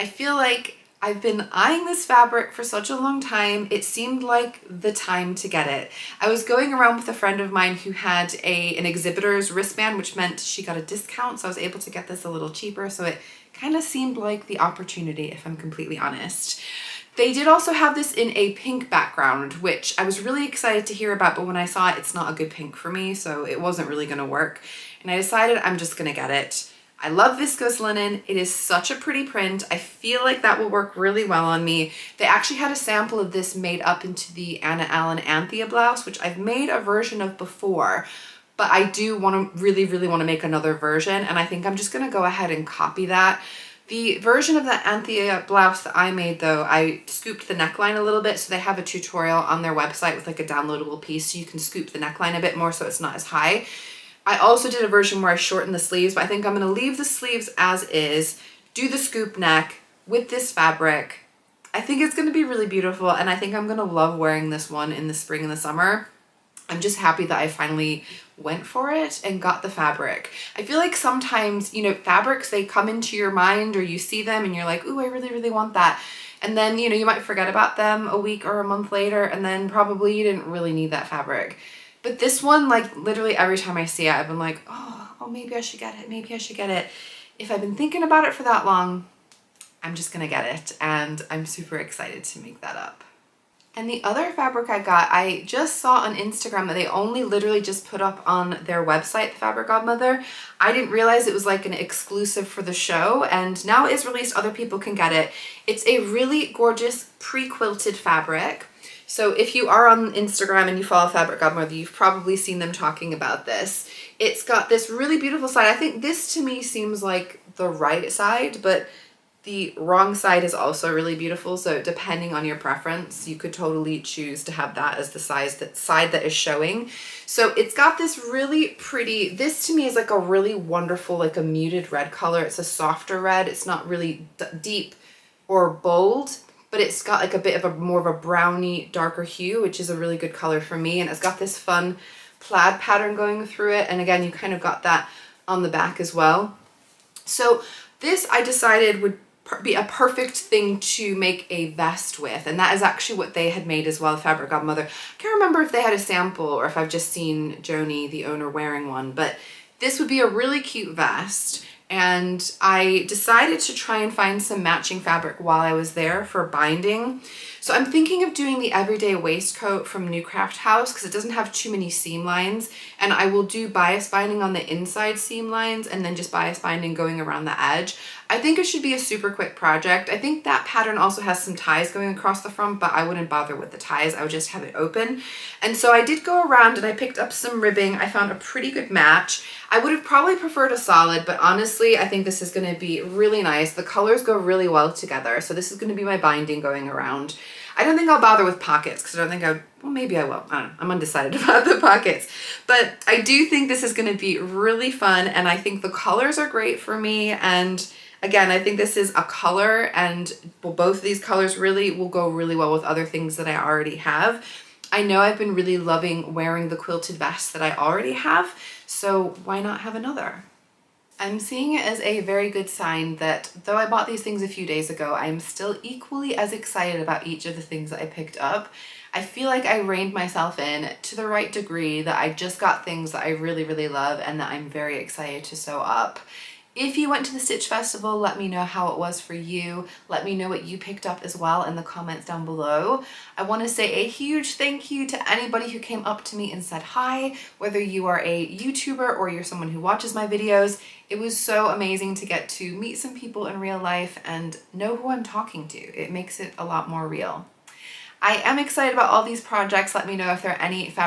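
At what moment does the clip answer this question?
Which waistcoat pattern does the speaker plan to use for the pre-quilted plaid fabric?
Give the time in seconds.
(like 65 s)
168 s.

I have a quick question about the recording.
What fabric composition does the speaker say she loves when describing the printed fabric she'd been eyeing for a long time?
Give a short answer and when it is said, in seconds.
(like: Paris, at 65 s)
viscose linen, at 27 s.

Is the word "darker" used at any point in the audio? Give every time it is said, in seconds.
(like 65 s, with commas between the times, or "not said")
138 s.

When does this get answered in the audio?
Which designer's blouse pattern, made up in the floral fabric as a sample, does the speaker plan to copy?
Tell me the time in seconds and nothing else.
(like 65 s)
34 s.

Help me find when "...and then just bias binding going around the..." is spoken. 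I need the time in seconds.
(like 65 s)
175 s.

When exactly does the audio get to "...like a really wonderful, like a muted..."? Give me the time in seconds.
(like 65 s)
129 s.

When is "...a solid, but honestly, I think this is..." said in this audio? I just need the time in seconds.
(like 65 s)
190 s.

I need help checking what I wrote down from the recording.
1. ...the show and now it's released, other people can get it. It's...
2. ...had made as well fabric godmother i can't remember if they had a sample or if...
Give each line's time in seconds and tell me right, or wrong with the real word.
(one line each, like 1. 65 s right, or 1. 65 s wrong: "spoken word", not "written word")
1. 102 s right
2. 153 s right.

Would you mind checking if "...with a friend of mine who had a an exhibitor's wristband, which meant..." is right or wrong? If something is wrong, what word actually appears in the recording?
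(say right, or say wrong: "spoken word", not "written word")
right.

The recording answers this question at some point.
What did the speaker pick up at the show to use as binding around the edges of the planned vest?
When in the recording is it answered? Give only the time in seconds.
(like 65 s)
187 s.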